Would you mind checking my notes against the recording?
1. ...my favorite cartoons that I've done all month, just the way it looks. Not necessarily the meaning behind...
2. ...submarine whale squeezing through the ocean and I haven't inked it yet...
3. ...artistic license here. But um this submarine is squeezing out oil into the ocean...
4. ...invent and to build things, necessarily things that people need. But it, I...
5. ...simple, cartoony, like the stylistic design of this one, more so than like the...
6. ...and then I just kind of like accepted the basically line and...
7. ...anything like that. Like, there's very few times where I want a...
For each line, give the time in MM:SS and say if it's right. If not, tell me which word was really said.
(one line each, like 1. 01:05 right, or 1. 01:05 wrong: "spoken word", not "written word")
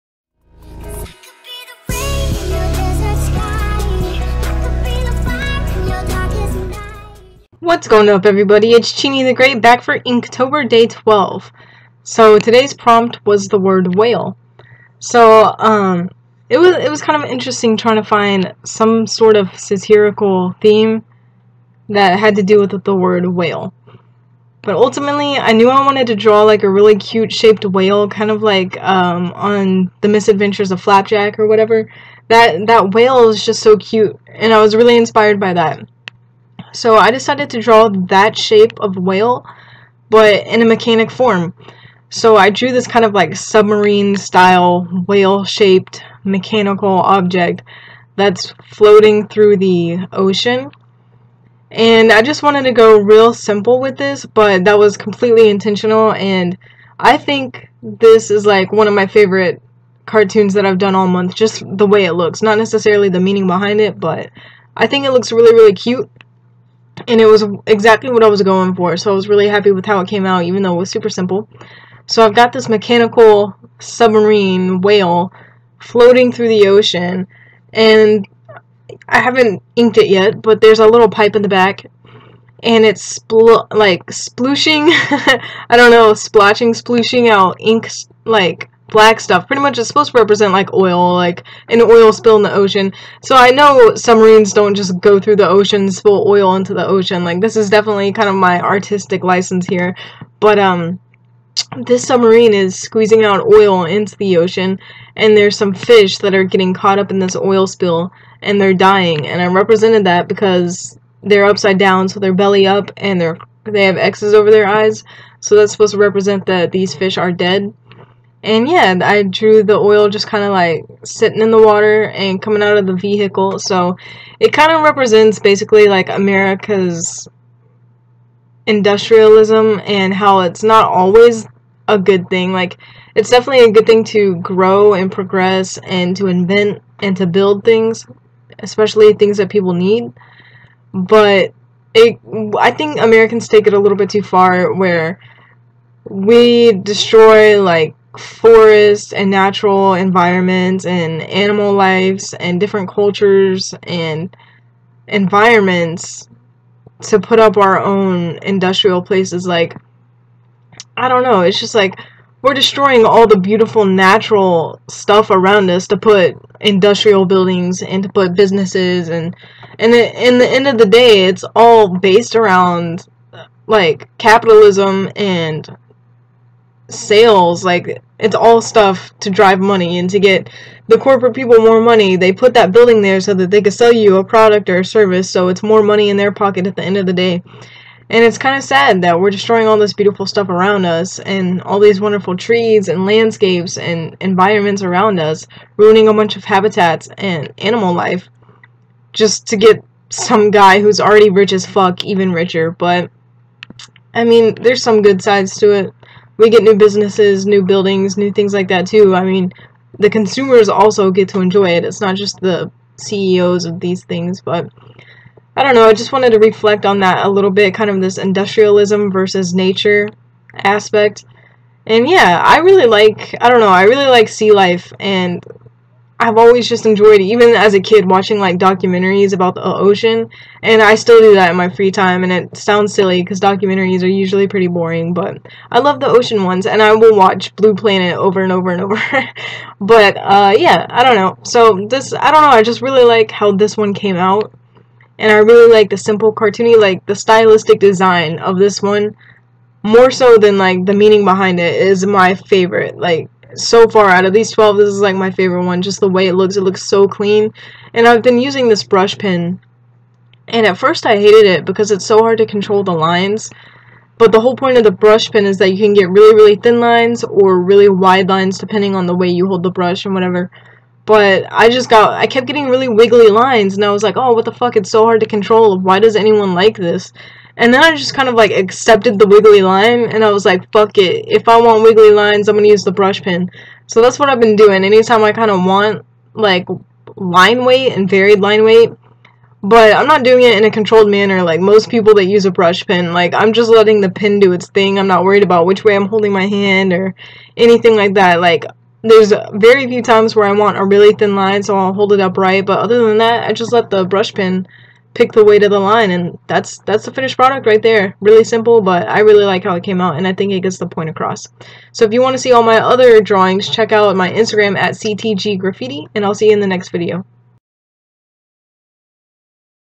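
1. 00:58 right
2. 01:13 wrong: "floating", not "squeezing"
3. 01:38 right
4. 02:16 wrong: "especially", not "necessarily"
5. 04:05 right
6. 04:37 wrong: "wiggly", not "basically"
7. 04:57 right.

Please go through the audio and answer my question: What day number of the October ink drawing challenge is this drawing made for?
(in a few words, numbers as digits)
12.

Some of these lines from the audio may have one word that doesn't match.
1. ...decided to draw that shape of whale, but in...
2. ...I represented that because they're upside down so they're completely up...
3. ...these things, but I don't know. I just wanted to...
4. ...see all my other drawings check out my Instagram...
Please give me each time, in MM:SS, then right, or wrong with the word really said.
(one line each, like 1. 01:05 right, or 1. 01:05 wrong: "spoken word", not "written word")
1. 00:37 right
2. 01:49 wrong: "belly", not "completely"
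3. 03:33 right
4. 05:12 right.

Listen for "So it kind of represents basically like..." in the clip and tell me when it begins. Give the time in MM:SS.
02:03.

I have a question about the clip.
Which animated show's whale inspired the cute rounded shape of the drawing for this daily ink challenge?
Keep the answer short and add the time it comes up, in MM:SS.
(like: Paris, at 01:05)
The Misadventures of Flapjack, at 00:30.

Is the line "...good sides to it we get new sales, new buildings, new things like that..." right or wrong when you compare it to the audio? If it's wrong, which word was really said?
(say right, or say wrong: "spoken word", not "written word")
wrong: "businesses", not "sales".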